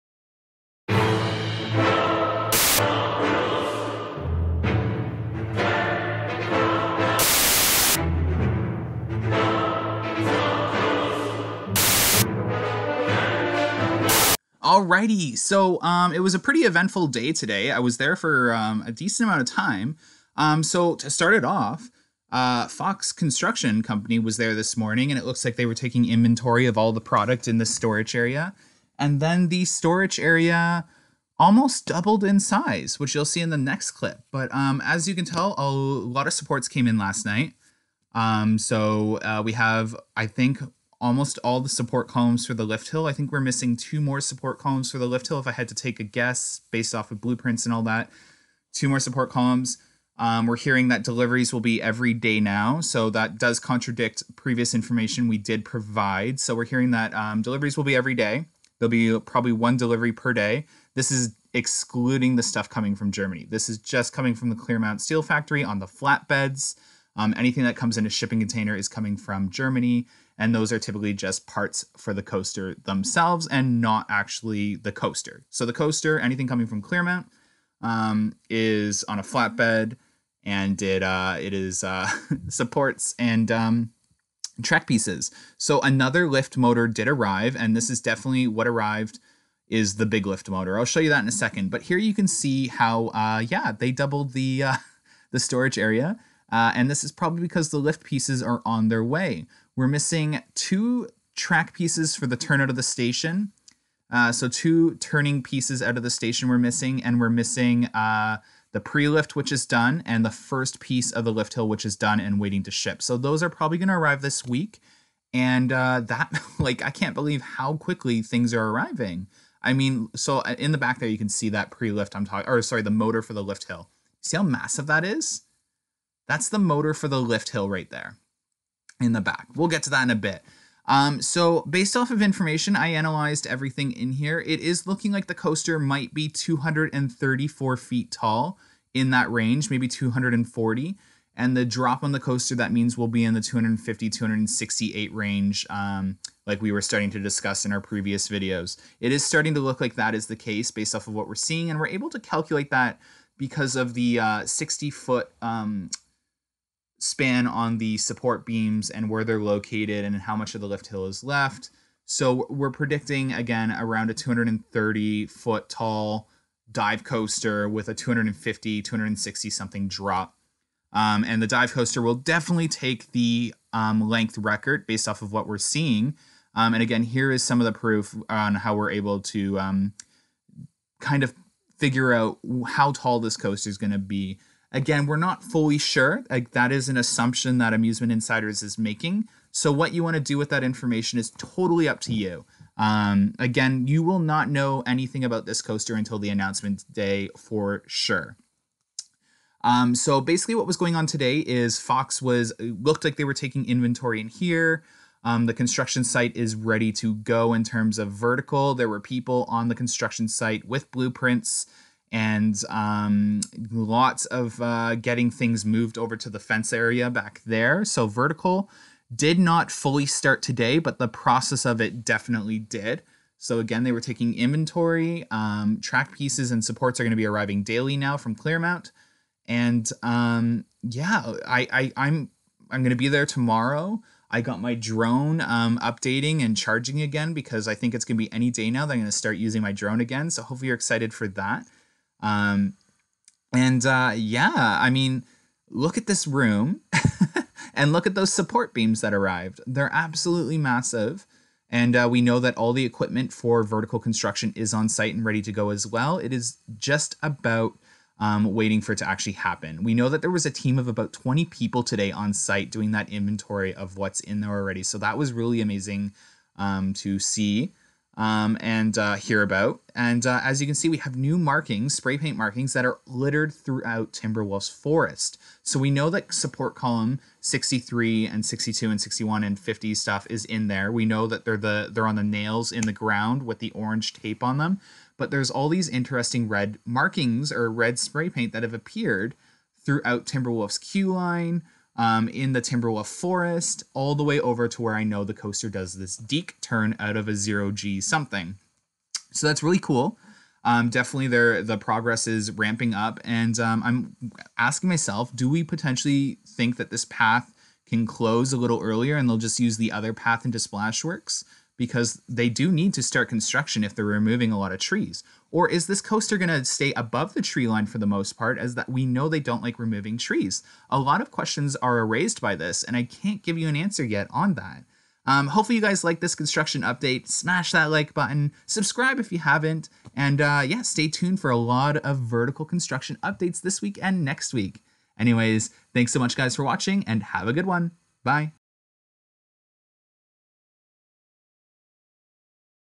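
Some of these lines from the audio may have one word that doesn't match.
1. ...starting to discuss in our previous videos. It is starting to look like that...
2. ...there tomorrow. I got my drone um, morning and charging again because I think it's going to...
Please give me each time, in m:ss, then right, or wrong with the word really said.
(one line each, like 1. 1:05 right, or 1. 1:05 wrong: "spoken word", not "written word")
1. 2:26 right
2. 3:53 wrong: "updating", not "morning".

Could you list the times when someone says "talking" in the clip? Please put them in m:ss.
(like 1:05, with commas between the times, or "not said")
2:02.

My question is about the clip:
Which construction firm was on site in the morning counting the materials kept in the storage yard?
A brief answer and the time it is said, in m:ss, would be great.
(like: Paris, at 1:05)
Fox Construction Company, at 0:22.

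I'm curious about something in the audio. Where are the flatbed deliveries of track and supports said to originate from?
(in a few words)
Clermont Steel Factory.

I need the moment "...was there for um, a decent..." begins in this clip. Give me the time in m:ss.
0:17.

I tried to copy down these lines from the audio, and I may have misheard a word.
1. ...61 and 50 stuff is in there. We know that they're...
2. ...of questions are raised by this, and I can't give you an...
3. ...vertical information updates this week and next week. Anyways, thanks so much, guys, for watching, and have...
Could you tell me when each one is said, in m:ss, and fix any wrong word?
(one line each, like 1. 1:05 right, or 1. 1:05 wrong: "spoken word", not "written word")
1. 4:39 right
2. 5:21 right
3. 5:32 wrong: "construction", not "information".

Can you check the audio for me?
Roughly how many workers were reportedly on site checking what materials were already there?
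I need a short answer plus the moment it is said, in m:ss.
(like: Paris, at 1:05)
20, at 4:21.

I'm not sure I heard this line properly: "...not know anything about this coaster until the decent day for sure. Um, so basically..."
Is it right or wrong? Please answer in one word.
wrong.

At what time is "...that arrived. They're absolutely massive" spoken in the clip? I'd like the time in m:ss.
4:09.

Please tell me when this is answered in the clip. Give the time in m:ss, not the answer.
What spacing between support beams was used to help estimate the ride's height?
2:34.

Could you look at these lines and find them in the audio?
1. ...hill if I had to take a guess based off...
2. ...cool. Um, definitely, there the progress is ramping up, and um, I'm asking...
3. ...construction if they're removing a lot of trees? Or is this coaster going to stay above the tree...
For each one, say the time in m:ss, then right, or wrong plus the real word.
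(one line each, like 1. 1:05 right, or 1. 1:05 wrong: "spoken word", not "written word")
1. 0:45 right
2. 4:59 right
3. 5:13 right.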